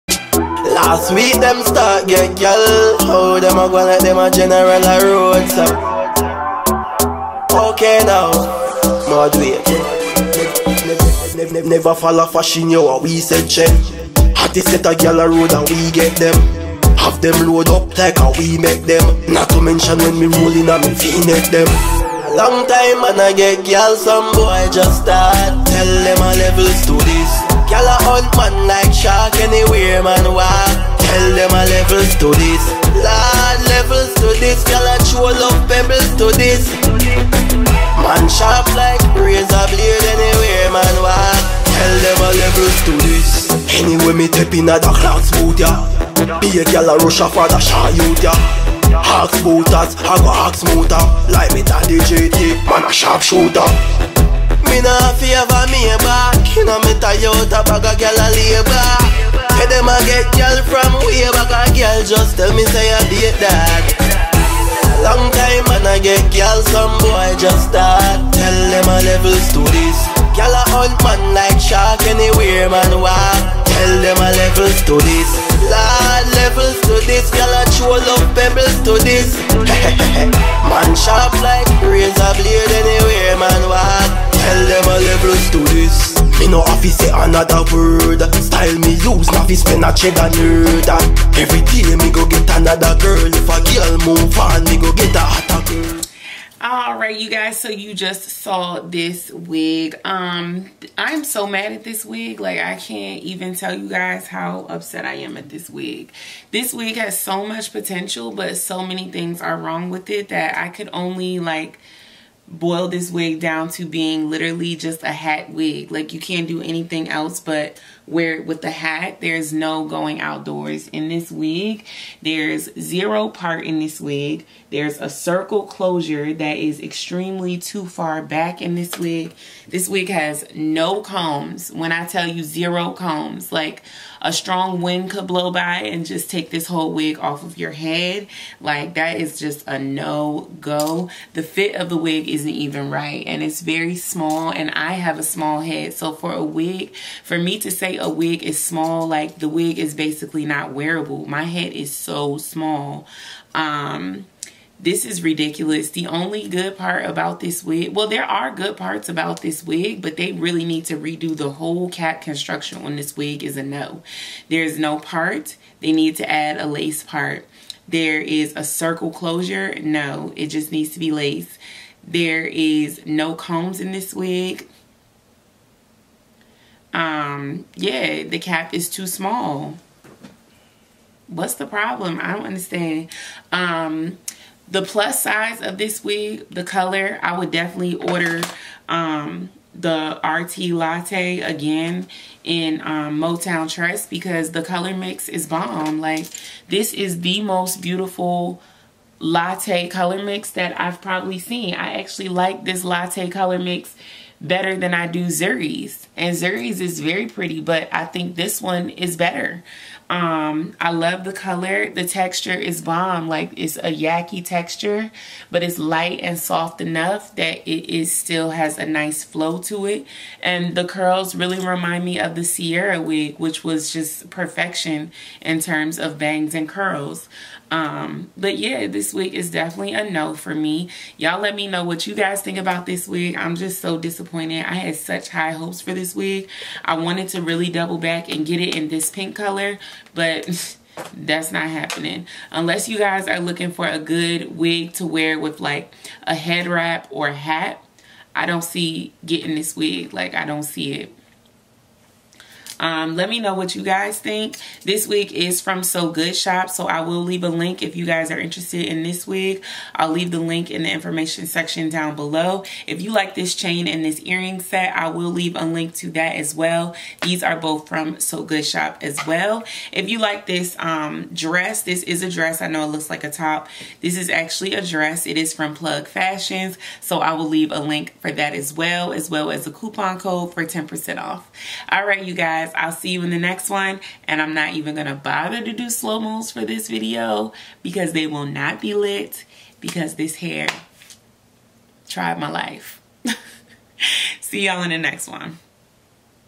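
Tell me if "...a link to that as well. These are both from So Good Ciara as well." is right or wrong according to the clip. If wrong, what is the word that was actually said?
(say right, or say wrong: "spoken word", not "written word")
wrong: "Shop", not "Ciara".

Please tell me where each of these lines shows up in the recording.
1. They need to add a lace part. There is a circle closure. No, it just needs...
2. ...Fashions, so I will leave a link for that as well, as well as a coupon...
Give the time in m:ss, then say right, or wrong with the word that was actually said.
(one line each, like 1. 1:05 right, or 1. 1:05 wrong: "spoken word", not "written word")
1. 2:45 right
2. 4:36 right.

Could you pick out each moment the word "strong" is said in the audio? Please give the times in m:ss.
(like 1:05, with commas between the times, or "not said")
2:14.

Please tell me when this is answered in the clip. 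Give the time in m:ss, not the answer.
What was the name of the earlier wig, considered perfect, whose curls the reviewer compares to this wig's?
3:42.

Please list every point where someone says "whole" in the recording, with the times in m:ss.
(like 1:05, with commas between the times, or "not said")
2:16, 2:41.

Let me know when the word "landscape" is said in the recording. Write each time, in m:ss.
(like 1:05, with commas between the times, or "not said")
not said.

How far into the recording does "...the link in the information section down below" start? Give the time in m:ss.
4:20.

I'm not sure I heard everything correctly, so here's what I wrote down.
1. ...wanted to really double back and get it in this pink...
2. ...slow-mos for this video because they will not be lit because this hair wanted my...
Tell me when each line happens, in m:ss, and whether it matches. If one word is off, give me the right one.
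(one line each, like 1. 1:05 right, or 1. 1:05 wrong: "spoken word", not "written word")
1. 3:56 right
2. 4:45 wrong: "tried", not "wanted".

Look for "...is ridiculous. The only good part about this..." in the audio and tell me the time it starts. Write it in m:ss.
2:35.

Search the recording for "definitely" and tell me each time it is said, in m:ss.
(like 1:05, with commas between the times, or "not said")
3:07, 3:49.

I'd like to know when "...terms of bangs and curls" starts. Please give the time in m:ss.
3:45.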